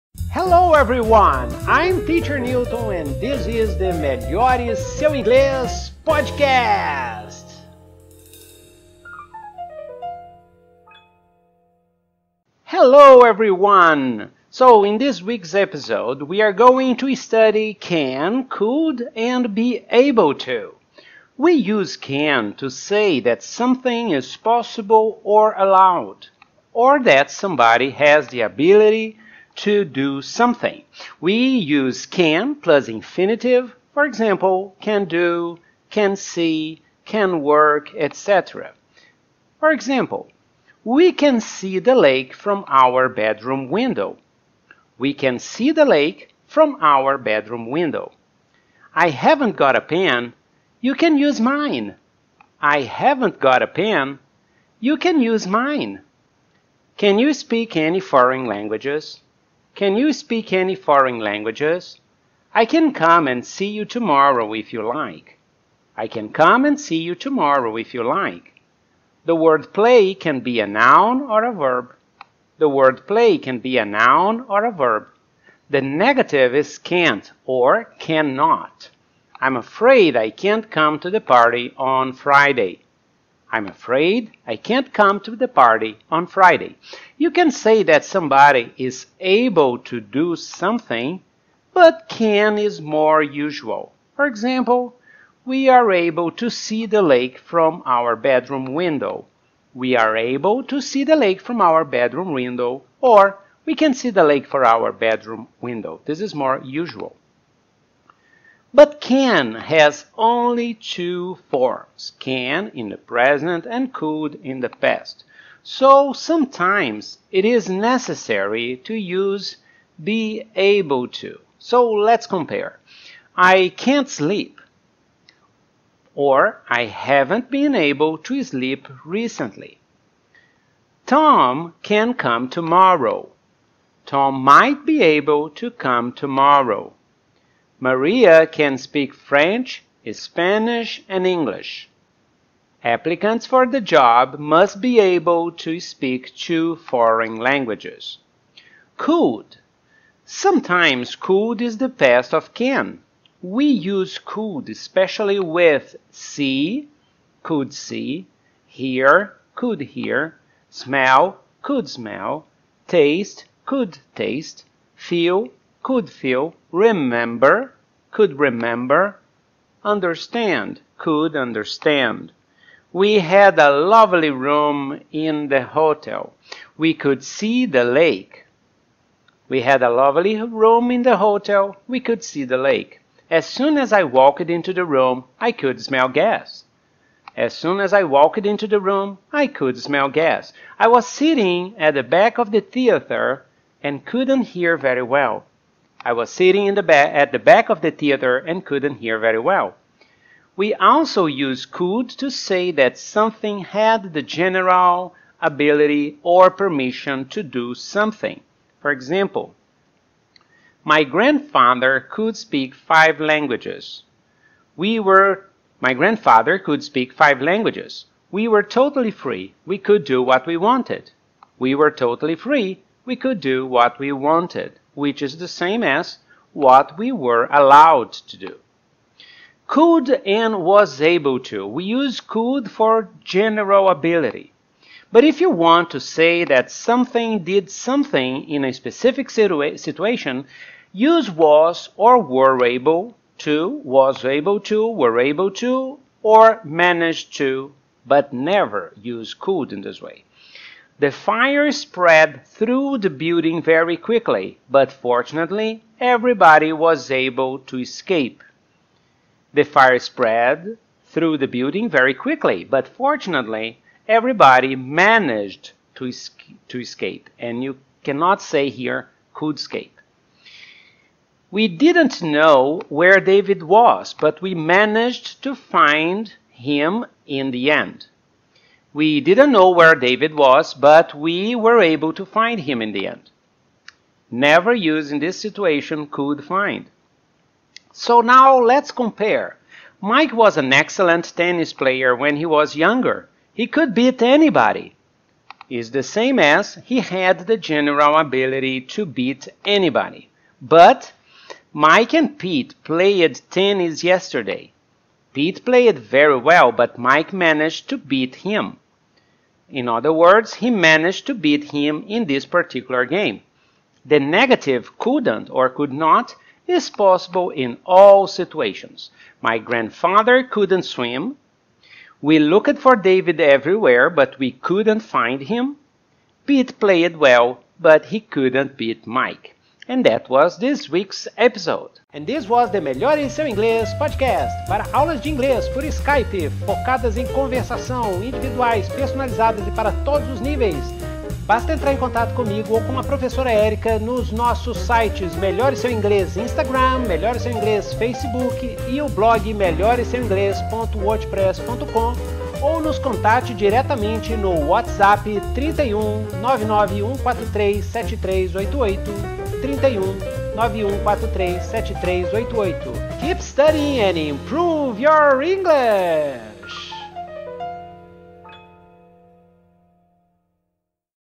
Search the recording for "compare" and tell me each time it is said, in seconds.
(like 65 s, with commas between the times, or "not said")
122 s, 288 s.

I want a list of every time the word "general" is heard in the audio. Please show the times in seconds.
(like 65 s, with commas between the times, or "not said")
204 s, 233 s, 297 s.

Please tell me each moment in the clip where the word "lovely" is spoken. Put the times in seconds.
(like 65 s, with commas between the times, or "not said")
173 s, 179 s.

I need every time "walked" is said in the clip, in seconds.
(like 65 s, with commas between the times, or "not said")
184 s, 188 s.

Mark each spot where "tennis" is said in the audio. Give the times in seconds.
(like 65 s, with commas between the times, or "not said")
291 s, 303 s.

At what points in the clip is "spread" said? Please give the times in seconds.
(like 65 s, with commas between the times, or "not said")
251 s, 259 s.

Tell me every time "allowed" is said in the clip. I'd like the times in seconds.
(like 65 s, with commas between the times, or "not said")
25 s, 227 s.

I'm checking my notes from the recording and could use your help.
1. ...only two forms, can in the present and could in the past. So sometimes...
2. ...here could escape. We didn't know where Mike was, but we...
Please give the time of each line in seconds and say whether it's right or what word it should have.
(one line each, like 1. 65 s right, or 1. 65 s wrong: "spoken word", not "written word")
1. 110 s right
2. 268 s wrong: "David", not "Mike".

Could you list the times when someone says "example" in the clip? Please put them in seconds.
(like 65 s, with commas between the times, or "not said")
34 s, 39 s, 94 s, 208 s.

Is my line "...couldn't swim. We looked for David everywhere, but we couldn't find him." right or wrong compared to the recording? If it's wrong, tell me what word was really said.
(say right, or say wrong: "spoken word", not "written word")
right.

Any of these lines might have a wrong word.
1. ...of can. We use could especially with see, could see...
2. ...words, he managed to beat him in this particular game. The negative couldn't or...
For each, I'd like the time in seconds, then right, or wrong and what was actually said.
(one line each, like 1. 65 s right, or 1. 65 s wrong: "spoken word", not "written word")
1. 152 s right
2. 310 s right.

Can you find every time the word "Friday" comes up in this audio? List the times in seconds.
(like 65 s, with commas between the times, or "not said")
82 s, 86 s.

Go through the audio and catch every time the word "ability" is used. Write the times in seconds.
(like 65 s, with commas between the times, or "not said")
28 s, 205 s, 233 s, 298 s.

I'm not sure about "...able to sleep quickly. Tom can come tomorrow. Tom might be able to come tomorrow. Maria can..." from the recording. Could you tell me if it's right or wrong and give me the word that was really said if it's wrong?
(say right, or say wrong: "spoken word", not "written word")
wrong: "recently", not "quickly".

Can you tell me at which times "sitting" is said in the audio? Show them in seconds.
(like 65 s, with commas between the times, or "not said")
191 s, 196 s.